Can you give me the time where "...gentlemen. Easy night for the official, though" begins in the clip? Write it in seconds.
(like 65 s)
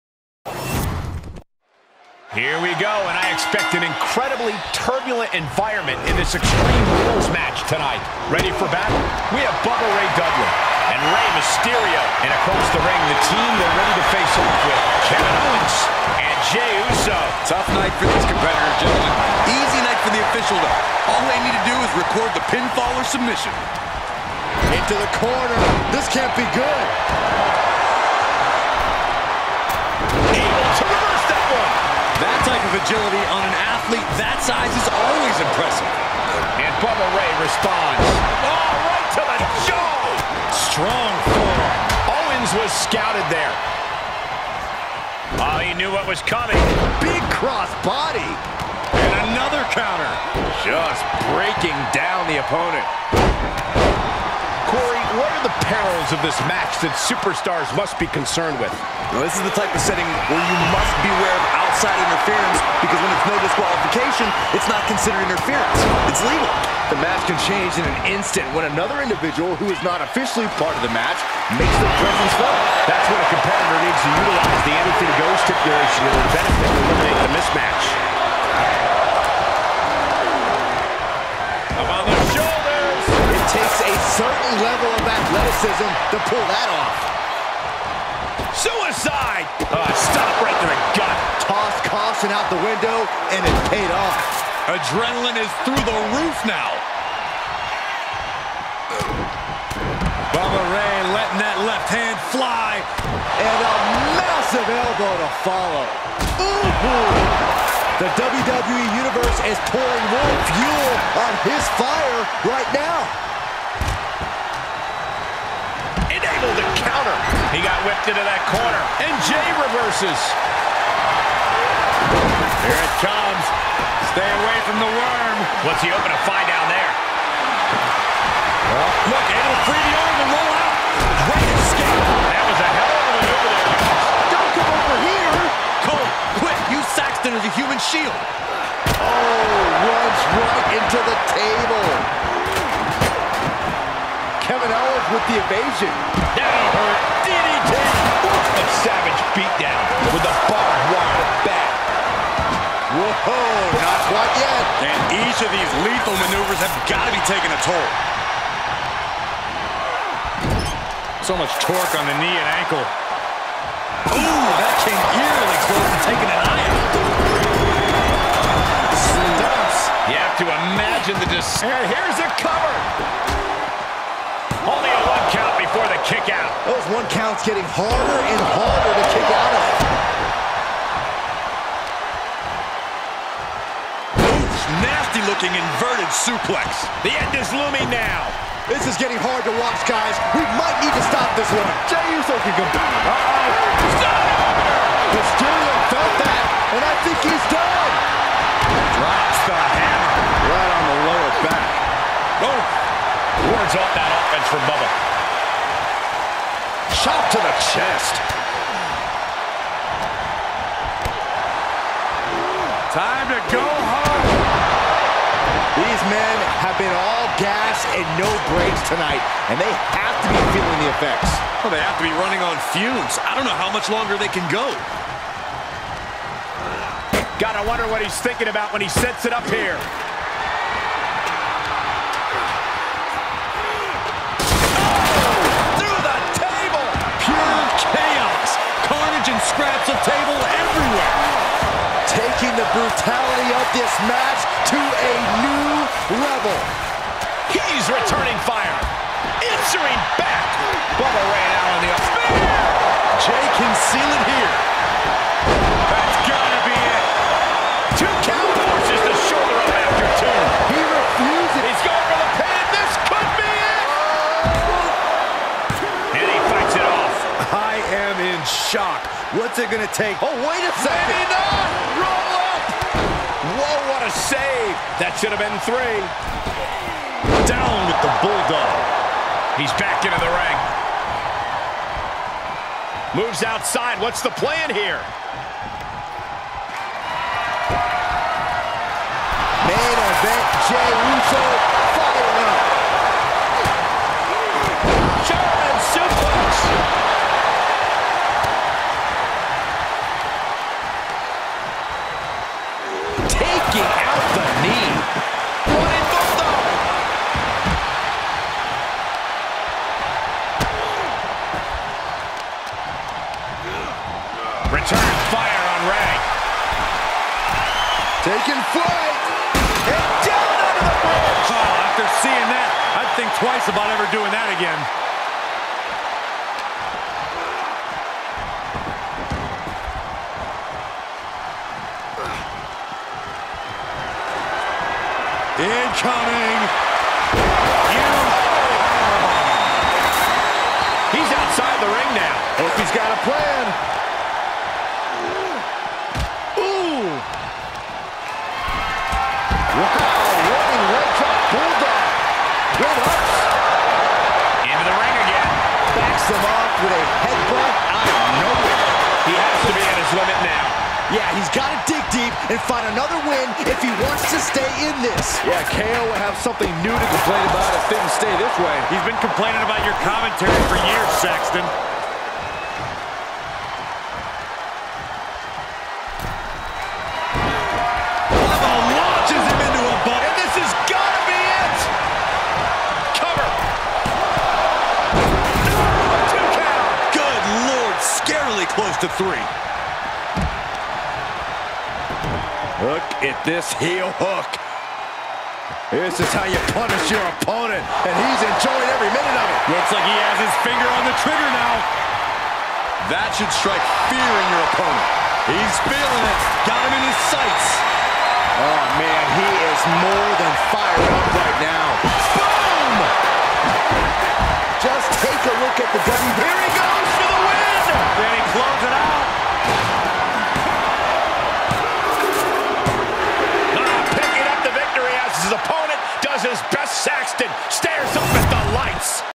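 18 s.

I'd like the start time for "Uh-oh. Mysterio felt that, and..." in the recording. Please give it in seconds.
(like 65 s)
193 s.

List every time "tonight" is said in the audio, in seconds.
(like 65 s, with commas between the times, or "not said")
7 s, 218 s.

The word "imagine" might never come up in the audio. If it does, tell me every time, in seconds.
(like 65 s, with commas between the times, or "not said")
170 s.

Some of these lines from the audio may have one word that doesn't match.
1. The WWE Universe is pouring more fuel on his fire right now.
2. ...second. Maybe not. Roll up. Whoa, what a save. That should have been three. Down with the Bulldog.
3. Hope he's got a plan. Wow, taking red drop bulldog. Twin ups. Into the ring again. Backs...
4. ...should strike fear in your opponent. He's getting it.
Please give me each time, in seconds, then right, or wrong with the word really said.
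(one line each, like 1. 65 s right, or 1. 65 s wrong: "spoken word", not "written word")
1. 108 s right
2. 270 s right
3. 342 s wrong: "running", not "taking"
4. 403 s wrong: "feeling", not "getting".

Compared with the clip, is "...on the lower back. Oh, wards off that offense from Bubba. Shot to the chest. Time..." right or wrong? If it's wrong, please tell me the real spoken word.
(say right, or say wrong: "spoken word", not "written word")
right.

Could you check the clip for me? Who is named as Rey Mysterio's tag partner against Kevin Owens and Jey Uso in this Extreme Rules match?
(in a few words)
Bubba Ray Dudley.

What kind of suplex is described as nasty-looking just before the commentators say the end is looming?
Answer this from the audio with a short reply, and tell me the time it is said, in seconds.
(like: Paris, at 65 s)
Inverted suplex, at 185 s.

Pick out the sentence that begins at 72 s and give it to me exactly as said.
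That's when a competitor needs to utilize the anything goes stipulation to benefit to eliminate the mismatch.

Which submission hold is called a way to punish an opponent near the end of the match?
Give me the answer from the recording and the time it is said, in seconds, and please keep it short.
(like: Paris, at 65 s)
Heel hook, at 393 s.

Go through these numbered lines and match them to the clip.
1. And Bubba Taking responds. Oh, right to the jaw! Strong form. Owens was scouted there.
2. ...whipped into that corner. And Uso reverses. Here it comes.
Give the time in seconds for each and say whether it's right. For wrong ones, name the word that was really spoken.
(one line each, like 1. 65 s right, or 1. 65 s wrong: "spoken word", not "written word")
1. 36 s wrong: "Ray", not "Taking"
2. 117 s wrong: "Jey", not "Uso".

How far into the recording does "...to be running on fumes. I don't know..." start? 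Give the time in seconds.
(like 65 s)
221 s.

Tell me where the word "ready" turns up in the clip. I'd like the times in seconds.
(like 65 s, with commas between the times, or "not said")
8 s, 13 s.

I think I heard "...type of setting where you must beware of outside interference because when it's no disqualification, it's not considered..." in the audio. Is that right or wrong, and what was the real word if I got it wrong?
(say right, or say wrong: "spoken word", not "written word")
right.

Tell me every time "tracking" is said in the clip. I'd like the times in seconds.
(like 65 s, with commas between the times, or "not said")
not said.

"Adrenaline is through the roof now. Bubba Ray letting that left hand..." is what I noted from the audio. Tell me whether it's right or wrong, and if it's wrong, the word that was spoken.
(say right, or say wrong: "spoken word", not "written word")
right.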